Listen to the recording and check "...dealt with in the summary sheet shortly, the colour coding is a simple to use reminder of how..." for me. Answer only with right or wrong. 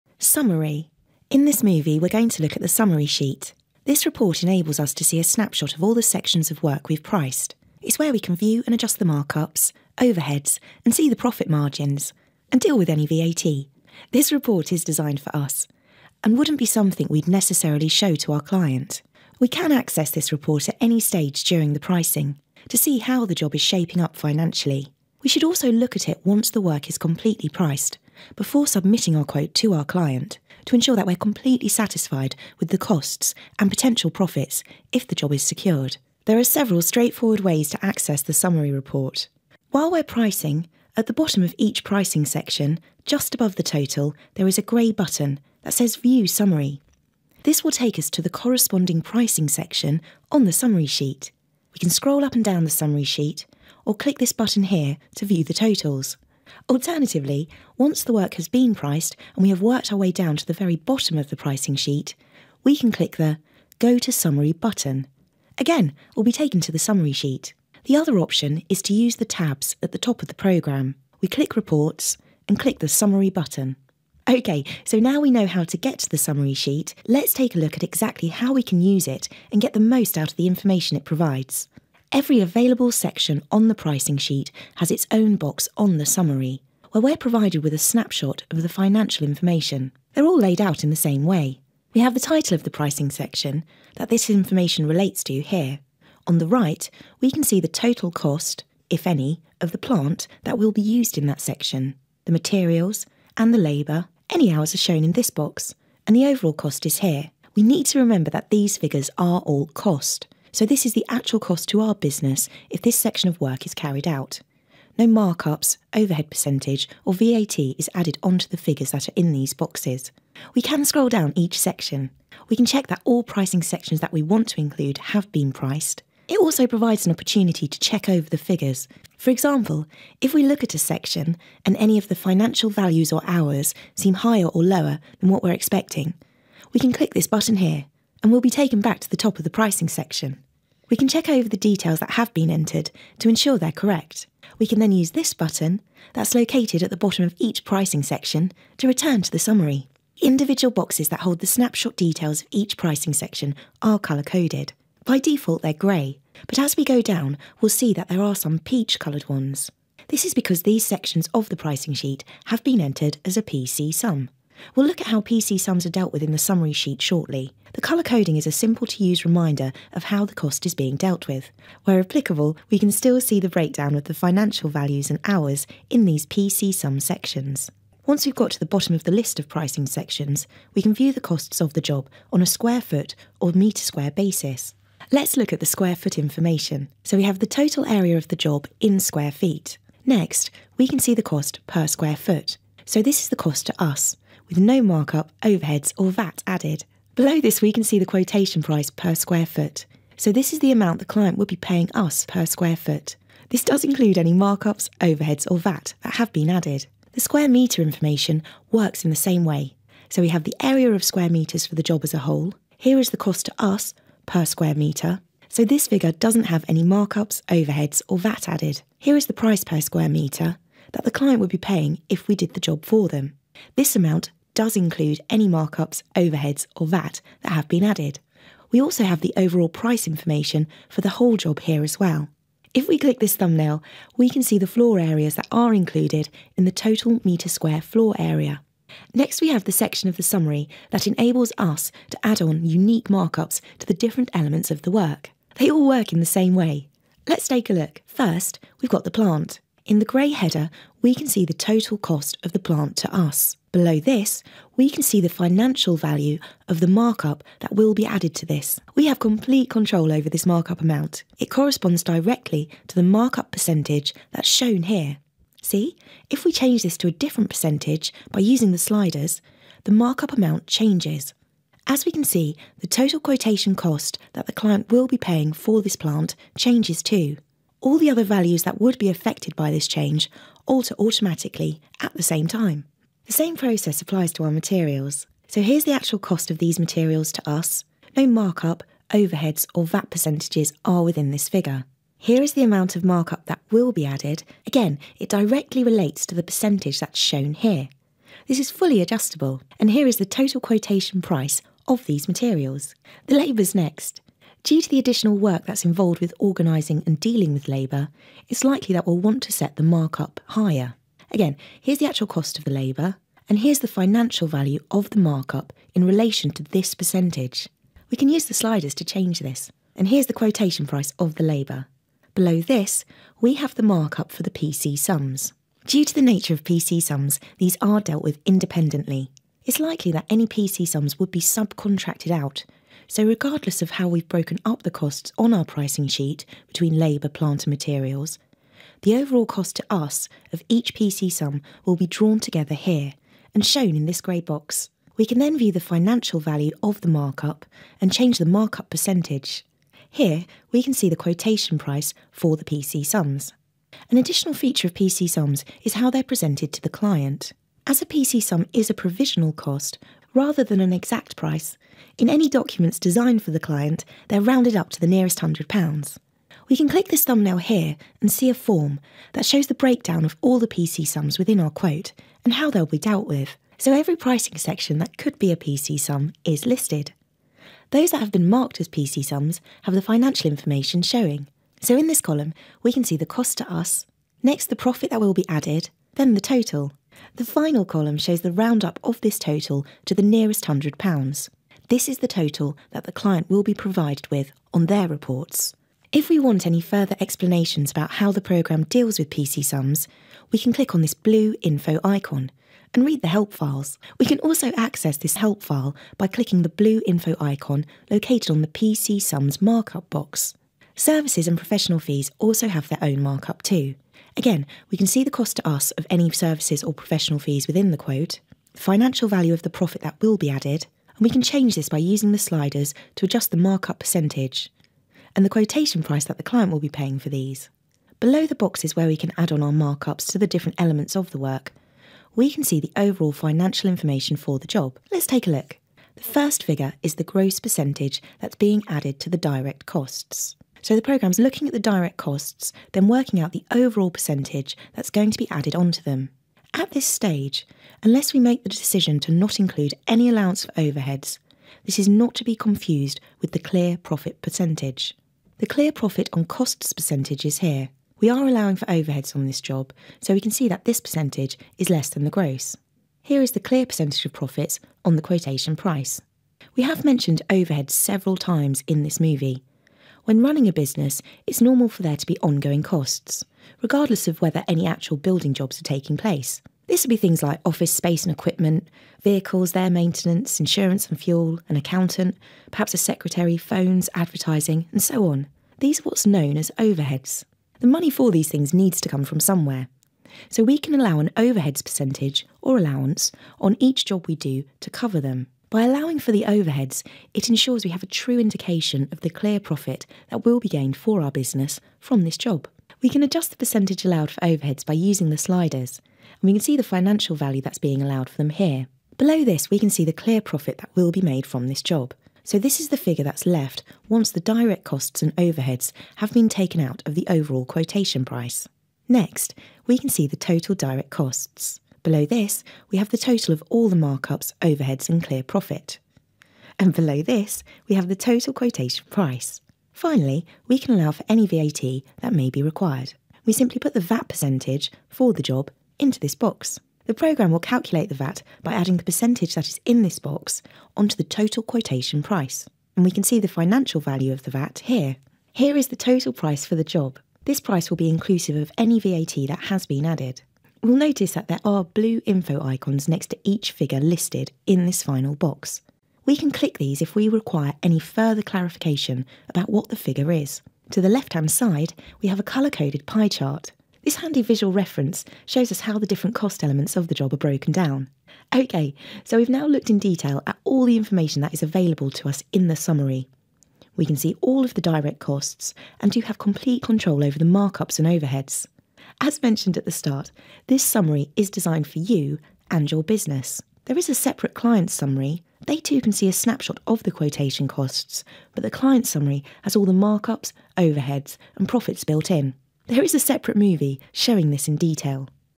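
right.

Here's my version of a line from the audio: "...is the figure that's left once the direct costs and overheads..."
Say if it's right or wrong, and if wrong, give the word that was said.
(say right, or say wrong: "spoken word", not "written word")
right.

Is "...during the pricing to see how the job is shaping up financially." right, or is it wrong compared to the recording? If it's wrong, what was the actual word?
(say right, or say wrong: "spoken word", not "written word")
right.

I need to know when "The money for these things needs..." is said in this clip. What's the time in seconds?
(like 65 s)
487 s.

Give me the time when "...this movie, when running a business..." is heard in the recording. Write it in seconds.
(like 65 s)
469 s.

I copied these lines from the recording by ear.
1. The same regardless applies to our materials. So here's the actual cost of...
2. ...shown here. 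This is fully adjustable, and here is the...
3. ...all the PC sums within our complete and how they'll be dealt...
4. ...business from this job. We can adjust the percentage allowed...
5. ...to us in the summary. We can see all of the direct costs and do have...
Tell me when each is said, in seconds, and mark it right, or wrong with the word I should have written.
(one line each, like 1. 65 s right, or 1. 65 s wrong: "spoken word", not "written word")
1. 283 s wrong: "process", not "regardless"
2. 297 s right
3. 370 s wrong: "quote", not "complete"
4. 501 s right
5. 572 s right.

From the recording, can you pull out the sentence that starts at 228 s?
We also have the overall price information for the whole job here as well.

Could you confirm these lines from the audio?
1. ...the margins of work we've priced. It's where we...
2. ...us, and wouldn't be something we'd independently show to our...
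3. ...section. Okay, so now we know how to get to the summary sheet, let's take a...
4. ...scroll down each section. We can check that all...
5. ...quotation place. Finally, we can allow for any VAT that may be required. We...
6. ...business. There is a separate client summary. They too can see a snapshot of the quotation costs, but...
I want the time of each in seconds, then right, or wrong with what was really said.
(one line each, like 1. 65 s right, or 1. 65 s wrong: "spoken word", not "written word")
1. 5 s wrong: "sections", not "margins"
2. 15 s wrong: "necessarily", not "independently"
3. 73 s wrong: "button", not "section"
4. 120 s right
5. 528 s wrong: "price", not "place"
6. 583 s right.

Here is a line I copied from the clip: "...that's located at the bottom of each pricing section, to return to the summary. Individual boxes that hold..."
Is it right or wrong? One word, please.
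right.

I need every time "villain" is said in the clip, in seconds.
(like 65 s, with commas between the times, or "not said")
not said.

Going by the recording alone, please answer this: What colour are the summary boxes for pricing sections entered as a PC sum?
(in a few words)
Peach.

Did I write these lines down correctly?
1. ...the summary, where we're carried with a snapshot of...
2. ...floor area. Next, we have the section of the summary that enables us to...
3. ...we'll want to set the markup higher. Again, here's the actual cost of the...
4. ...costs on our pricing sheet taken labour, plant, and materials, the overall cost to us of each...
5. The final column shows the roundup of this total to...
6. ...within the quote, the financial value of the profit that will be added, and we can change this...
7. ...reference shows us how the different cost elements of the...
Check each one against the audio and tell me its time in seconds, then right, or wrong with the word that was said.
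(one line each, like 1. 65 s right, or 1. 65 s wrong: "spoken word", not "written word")
1. 85 s wrong: "provided", not "carried"
2. 237 s right
3. 309 s right
4. 334 s wrong: "between", not "taken"
5. 387 s right
6. 417 s right
7. 564 s right.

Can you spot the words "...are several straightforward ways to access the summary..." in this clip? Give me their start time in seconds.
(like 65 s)
36 s.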